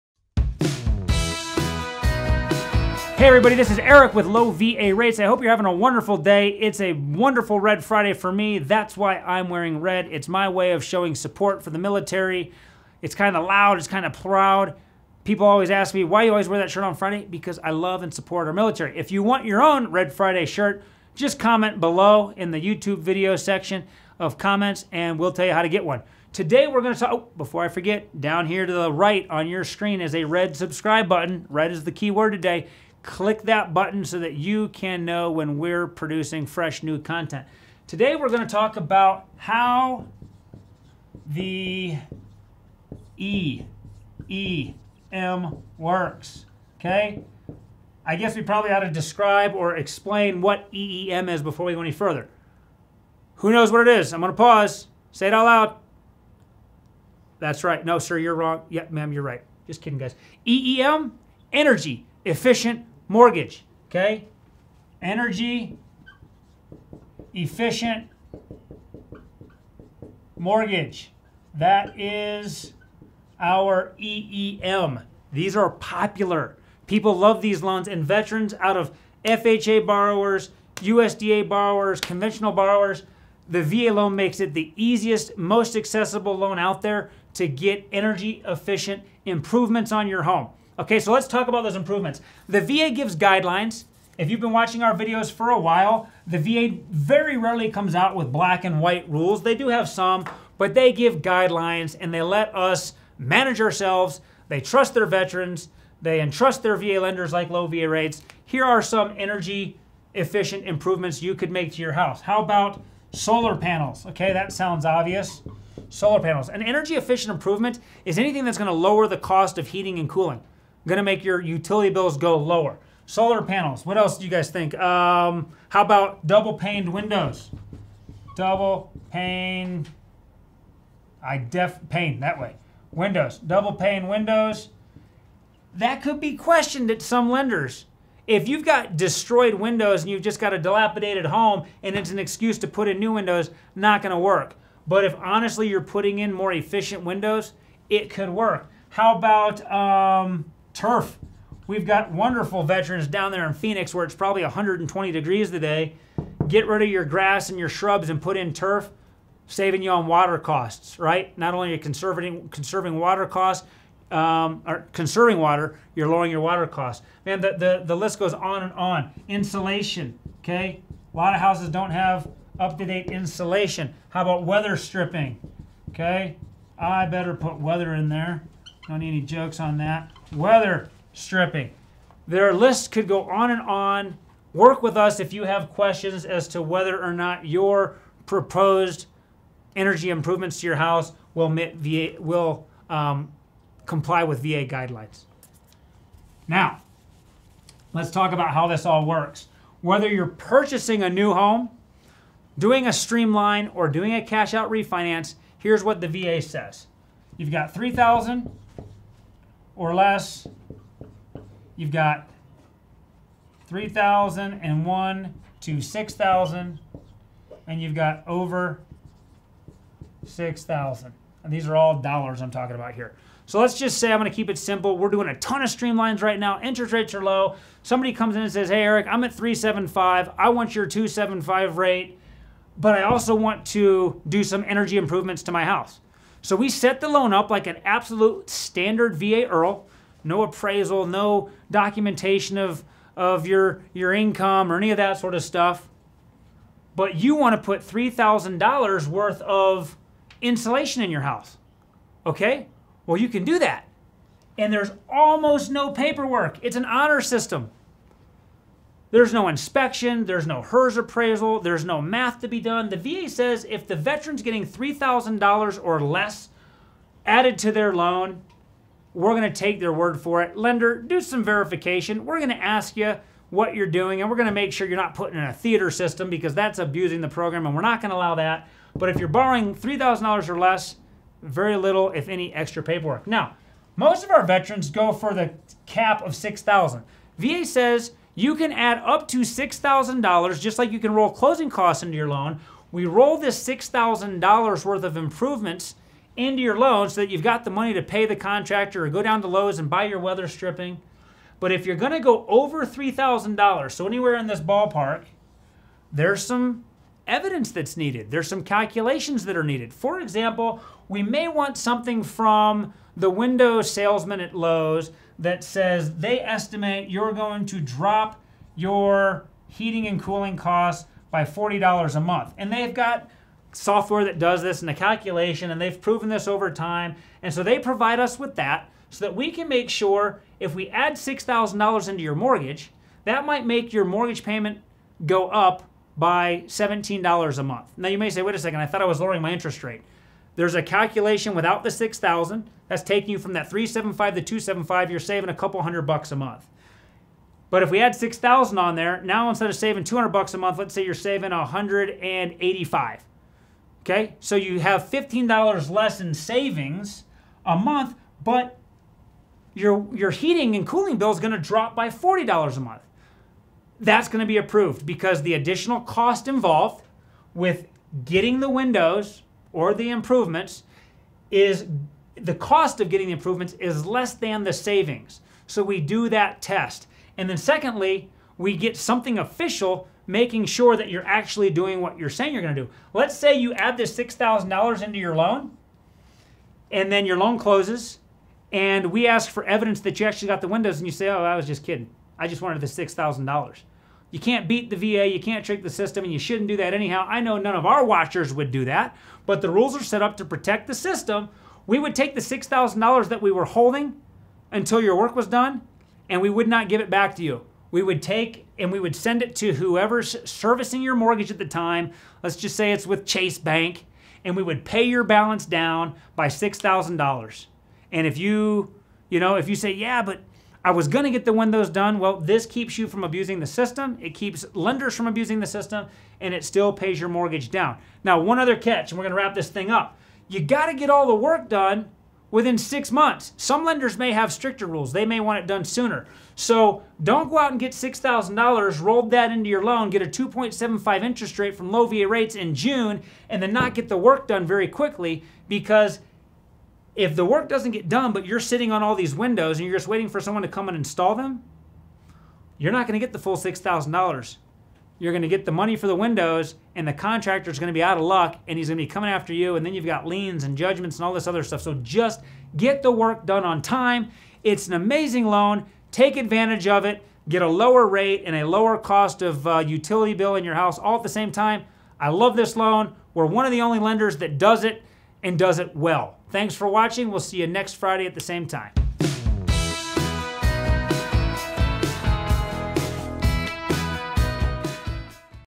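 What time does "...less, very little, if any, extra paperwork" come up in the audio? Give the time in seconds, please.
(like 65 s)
280 s.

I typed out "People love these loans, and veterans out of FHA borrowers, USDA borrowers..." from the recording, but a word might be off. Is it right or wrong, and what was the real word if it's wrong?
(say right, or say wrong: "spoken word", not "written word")
right.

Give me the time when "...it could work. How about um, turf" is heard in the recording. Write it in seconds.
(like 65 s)
147 s.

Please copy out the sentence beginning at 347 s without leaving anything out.
But if we add 6,000 on there, now instead of saving 200 bucks a month, let's say you're saving 185.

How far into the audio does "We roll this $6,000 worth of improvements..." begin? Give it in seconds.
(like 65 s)
292 s.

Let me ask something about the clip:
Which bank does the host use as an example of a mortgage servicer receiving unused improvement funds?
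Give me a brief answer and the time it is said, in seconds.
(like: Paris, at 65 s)
Chase Bank, at 413 s.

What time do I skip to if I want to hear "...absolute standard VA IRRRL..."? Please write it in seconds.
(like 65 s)
237 s.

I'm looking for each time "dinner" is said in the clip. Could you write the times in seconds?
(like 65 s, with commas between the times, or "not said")
not said.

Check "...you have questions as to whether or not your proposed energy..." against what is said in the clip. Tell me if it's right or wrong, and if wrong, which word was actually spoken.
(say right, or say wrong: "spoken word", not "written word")
right.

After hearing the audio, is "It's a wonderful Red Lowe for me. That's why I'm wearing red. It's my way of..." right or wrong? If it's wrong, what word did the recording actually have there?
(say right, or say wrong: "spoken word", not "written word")
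wrong: "Friday", not "Lowe".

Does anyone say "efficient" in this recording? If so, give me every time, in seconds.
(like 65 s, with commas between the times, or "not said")
62 s, 67 s, 88 s, 110 s, 116 s, 146 s.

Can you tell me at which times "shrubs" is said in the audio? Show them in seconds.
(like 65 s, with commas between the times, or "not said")
157 s.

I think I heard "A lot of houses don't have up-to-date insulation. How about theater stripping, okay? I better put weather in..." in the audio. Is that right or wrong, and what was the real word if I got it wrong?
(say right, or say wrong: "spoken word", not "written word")
wrong: "weather", not "theater".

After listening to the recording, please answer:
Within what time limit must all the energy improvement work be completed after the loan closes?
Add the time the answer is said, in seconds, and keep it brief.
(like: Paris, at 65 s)
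six months, at 432 s.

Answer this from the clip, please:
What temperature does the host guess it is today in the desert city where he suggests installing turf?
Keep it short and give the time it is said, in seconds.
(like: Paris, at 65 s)
120 degrees, at 154 s.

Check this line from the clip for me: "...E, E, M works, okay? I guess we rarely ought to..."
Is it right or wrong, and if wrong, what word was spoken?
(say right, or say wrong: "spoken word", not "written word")
wrong: "probably", not "rarely".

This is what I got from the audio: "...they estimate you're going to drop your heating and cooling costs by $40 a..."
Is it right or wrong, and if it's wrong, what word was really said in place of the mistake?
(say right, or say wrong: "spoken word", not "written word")
right.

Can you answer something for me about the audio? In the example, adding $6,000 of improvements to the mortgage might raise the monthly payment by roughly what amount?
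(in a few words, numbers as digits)
$17.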